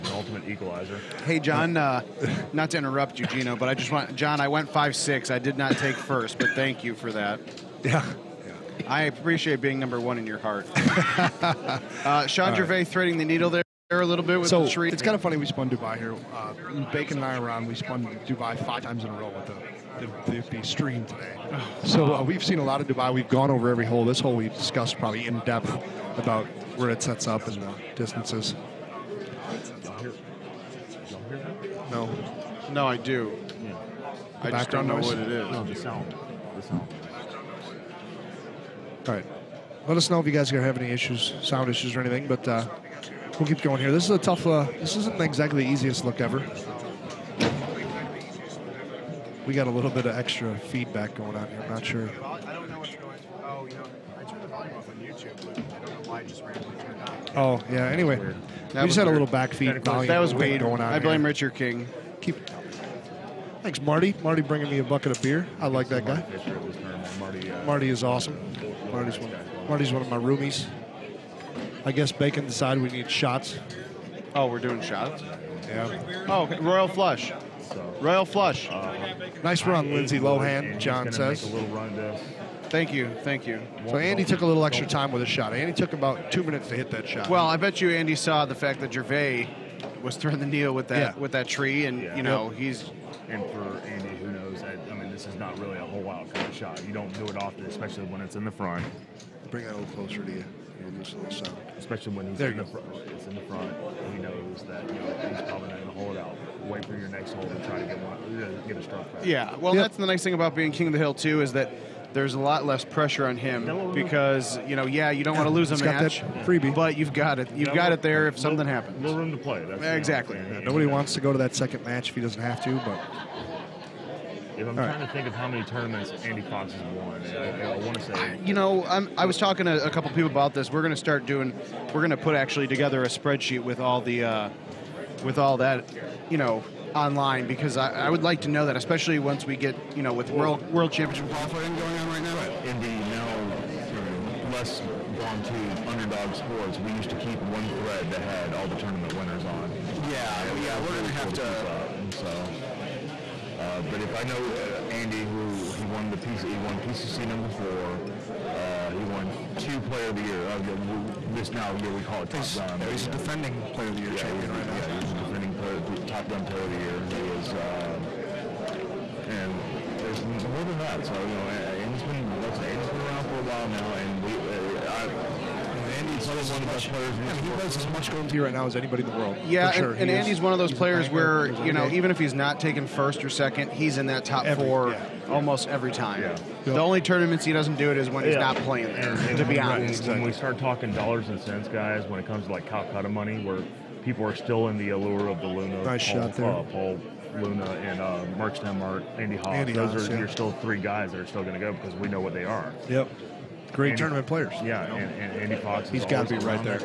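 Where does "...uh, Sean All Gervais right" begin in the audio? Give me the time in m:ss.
0:12.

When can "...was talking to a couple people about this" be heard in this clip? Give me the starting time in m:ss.
2:09.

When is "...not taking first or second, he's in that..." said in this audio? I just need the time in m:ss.
3:02.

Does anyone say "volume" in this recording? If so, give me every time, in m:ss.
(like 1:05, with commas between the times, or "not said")
0:54, 0:59.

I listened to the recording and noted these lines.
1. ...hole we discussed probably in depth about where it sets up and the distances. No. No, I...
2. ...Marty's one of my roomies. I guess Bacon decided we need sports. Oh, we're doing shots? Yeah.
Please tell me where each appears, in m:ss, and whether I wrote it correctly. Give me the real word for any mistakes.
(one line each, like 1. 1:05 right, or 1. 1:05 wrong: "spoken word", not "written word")
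1. 0:24 right
2. 1:09 wrong: "shots", not "sports".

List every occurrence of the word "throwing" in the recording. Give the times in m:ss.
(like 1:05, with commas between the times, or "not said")
1:30.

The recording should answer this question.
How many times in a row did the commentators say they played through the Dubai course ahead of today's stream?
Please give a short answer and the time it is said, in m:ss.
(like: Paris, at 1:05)
5, at 0:18.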